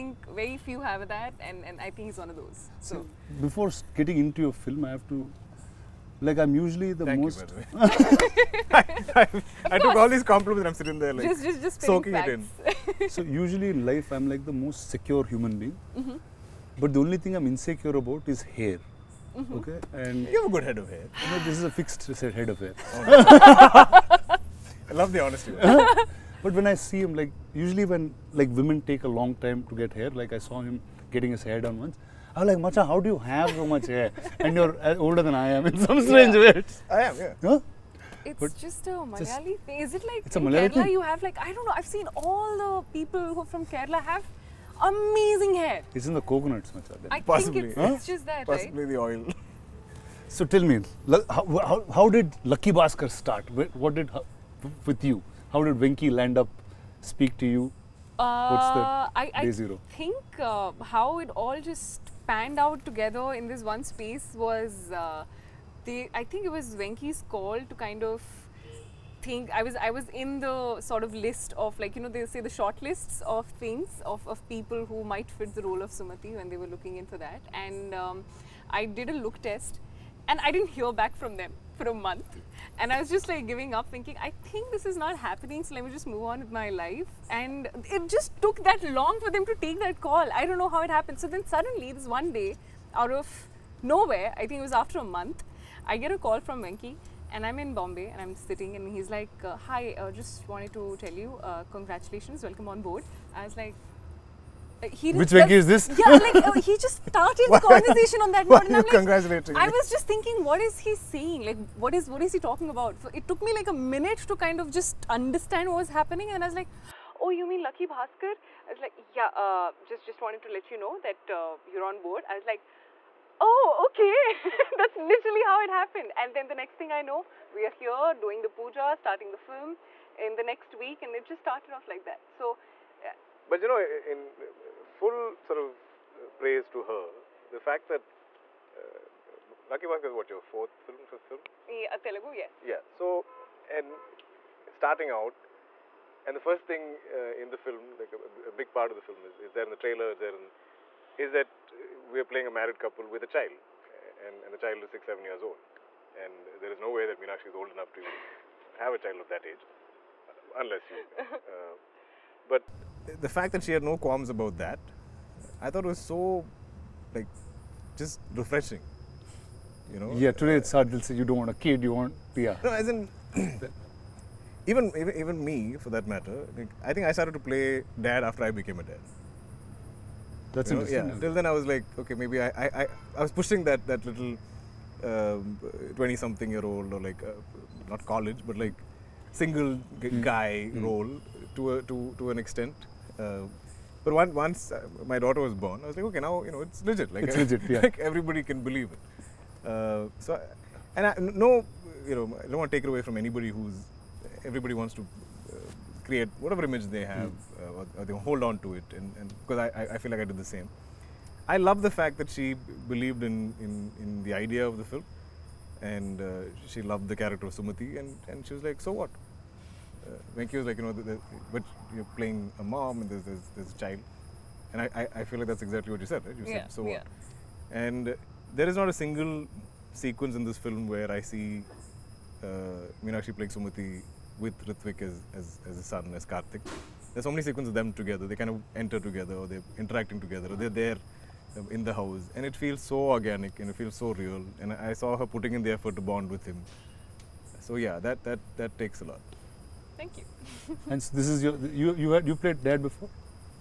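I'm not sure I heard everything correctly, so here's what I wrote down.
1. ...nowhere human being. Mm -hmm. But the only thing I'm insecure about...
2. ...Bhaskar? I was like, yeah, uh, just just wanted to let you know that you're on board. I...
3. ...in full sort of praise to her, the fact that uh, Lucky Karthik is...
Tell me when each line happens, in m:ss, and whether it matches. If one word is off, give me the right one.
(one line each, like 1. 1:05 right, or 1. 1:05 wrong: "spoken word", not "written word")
1. 0:14 wrong: "secure", not "nowhere"
2. 1:57 right
3. 2:13 wrong: "Bhaskar", not "Karthik".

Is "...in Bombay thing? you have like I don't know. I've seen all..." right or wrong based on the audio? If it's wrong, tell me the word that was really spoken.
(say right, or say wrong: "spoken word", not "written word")
wrong: "Kerala", not "Bombay".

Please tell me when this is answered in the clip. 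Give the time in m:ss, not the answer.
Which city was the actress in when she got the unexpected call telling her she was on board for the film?
1:37.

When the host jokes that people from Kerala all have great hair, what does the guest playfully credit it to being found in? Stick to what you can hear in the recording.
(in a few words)
the coconuts.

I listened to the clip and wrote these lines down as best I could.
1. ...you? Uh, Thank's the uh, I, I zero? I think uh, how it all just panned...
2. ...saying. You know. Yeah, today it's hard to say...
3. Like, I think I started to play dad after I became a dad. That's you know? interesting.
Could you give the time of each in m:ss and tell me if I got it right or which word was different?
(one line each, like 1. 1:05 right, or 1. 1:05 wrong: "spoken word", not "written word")
1. 0:57 wrong: "What", not "Thank"
2. 2:48 wrong: "refreshing", not "saying"
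3. 2:56 right.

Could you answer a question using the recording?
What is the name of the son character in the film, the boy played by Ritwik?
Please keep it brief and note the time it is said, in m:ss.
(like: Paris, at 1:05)
Karthik, at 3:56.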